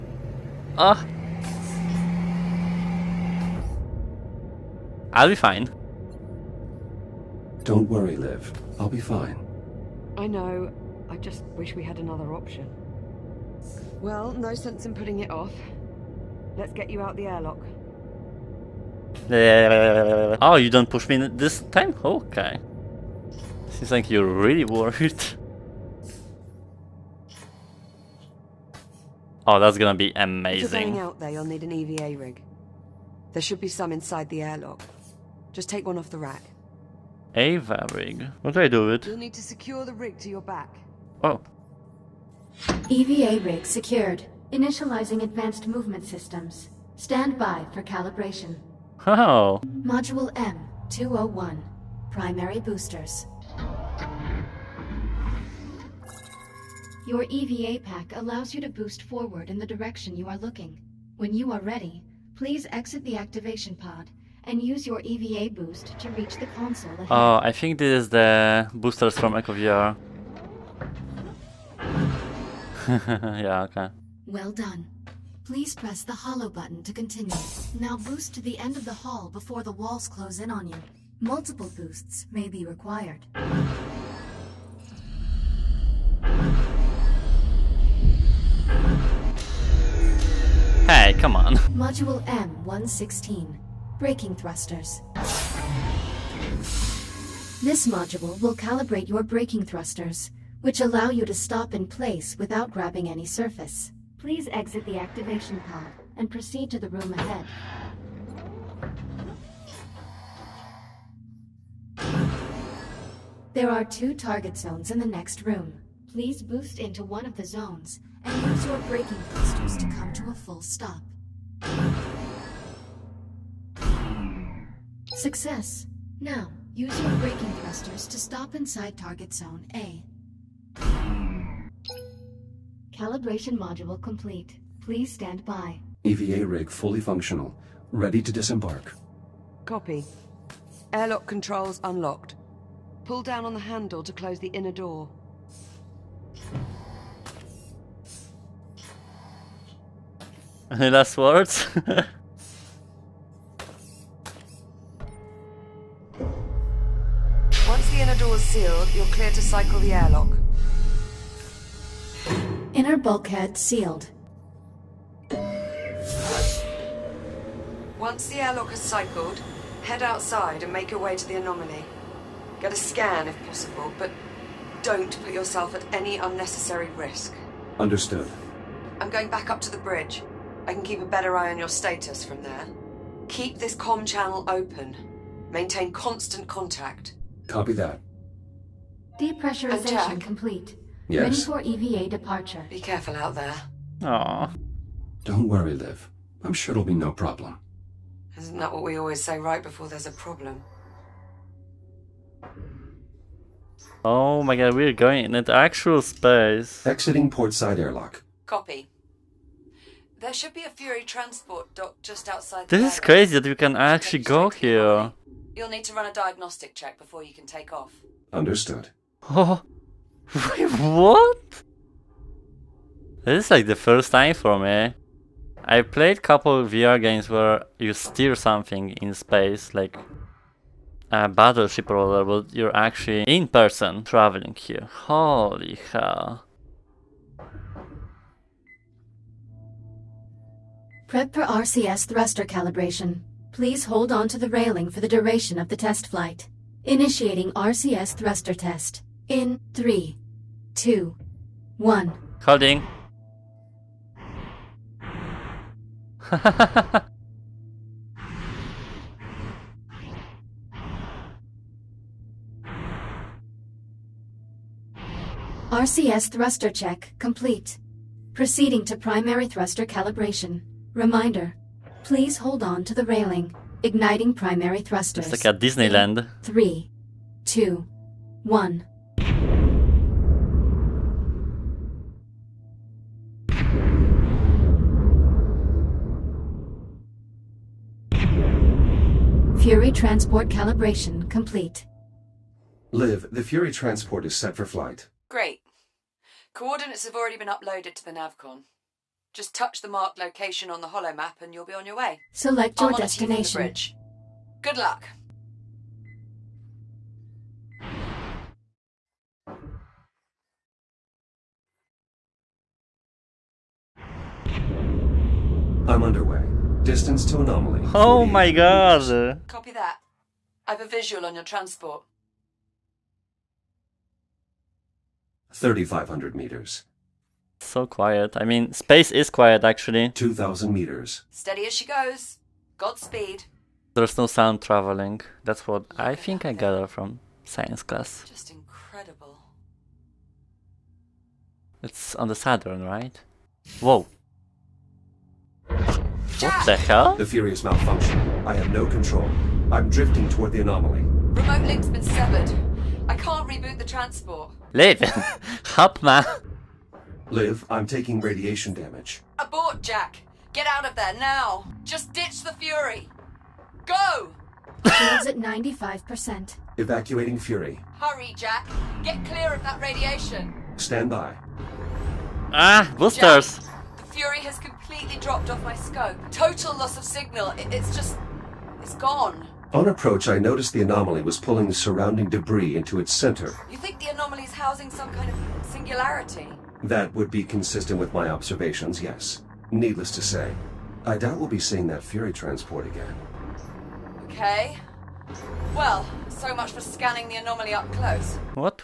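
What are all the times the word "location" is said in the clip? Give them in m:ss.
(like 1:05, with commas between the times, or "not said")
5:00.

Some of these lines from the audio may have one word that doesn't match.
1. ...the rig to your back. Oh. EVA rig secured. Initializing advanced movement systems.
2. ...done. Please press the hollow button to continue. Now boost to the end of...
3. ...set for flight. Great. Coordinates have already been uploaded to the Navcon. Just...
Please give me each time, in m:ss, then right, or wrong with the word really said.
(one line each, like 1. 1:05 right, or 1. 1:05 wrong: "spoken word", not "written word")
1. 0:39 right
2. 1:14 right
3. 4:54 right.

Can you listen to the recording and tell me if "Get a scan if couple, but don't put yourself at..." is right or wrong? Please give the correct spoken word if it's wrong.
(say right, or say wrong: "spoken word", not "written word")
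wrong: "possible", not "couple".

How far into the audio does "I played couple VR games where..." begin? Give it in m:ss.
3:45.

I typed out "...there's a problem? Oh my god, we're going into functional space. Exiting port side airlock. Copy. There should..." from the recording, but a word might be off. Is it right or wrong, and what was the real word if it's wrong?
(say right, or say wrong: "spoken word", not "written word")
wrong: "actual", not "functional".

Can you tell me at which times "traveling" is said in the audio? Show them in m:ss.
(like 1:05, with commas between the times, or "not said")
3:54, 5:34.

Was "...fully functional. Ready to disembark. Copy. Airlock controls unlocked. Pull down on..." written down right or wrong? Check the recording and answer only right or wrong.
right.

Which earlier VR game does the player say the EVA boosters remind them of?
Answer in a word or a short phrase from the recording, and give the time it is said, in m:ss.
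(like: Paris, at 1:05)
Echo VR, at 1:09.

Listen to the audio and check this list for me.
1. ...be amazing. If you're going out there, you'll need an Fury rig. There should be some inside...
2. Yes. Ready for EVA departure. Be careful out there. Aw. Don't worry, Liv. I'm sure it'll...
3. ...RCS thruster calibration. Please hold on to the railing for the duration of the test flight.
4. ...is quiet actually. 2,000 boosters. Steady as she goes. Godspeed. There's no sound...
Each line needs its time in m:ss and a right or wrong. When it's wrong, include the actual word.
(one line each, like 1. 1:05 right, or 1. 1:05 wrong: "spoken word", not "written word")
1. 0:29 wrong: "EVA", not "Fury"
2. 3:11 right
3. 4:01 right
4. 5:29 wrong: "meters", not "boosters".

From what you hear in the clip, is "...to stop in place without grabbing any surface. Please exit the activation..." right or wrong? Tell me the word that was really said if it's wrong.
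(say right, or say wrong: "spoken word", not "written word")
right.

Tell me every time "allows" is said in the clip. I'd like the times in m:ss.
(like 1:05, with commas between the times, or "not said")
0:58, 1:40.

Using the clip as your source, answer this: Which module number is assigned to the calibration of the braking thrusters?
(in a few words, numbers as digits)
M116.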